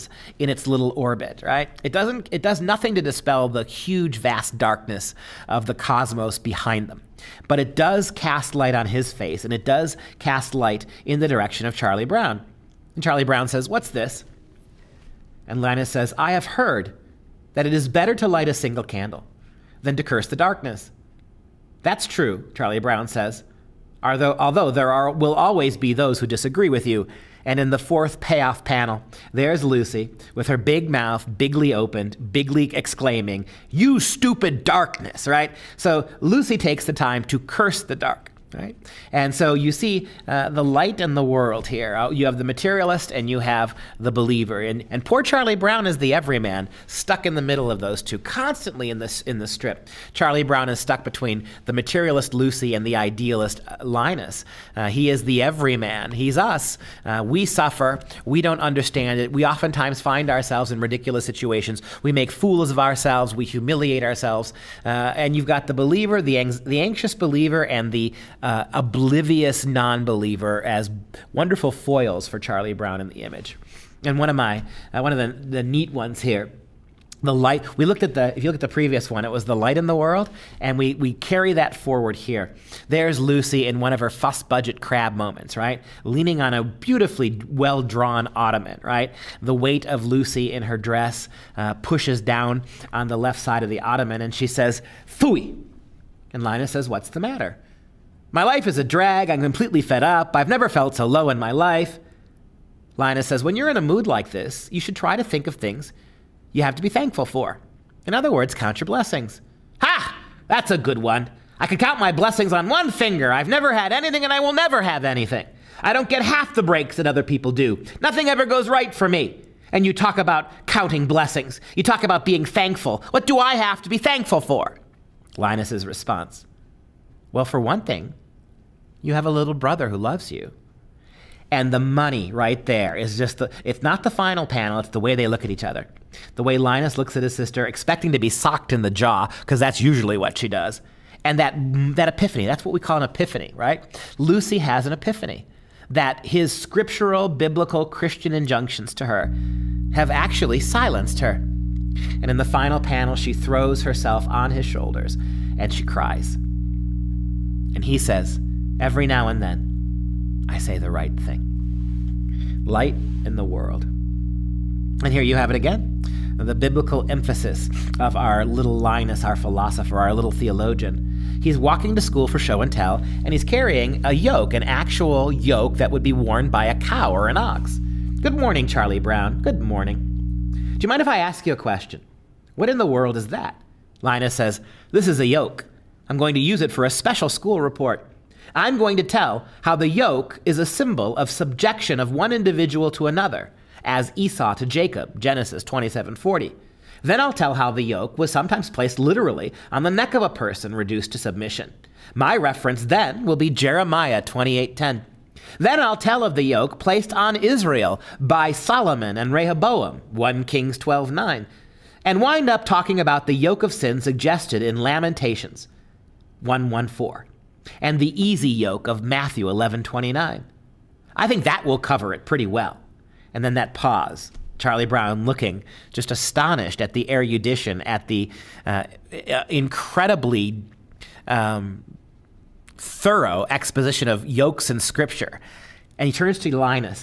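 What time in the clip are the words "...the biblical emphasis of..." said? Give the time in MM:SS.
02:46.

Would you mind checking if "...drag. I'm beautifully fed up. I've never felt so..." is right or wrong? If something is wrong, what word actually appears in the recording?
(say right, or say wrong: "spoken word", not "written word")
wrong: "completely", not "beautifully".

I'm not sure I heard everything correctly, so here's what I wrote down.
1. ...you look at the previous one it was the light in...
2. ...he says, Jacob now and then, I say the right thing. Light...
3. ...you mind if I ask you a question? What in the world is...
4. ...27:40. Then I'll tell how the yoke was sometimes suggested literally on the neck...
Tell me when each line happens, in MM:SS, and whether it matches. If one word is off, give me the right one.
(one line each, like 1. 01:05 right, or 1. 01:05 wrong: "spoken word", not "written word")
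1. 01:18 right
2. 02:37 wrong: "Every", not "Jacob"
3. 03:00 right
4. 03:15 wrong: "placed", not "suggested".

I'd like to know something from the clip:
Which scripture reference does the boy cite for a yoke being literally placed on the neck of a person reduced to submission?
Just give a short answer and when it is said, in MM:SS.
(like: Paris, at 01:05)
Jeremiah 28:10, at 03:23.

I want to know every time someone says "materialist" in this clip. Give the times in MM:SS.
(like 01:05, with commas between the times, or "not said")
00:42, 00:51.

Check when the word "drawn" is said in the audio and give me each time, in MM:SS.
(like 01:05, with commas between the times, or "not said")
01:27.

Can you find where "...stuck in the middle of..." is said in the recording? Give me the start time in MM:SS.
00:46.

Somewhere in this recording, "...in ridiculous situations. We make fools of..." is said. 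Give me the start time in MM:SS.
01:00.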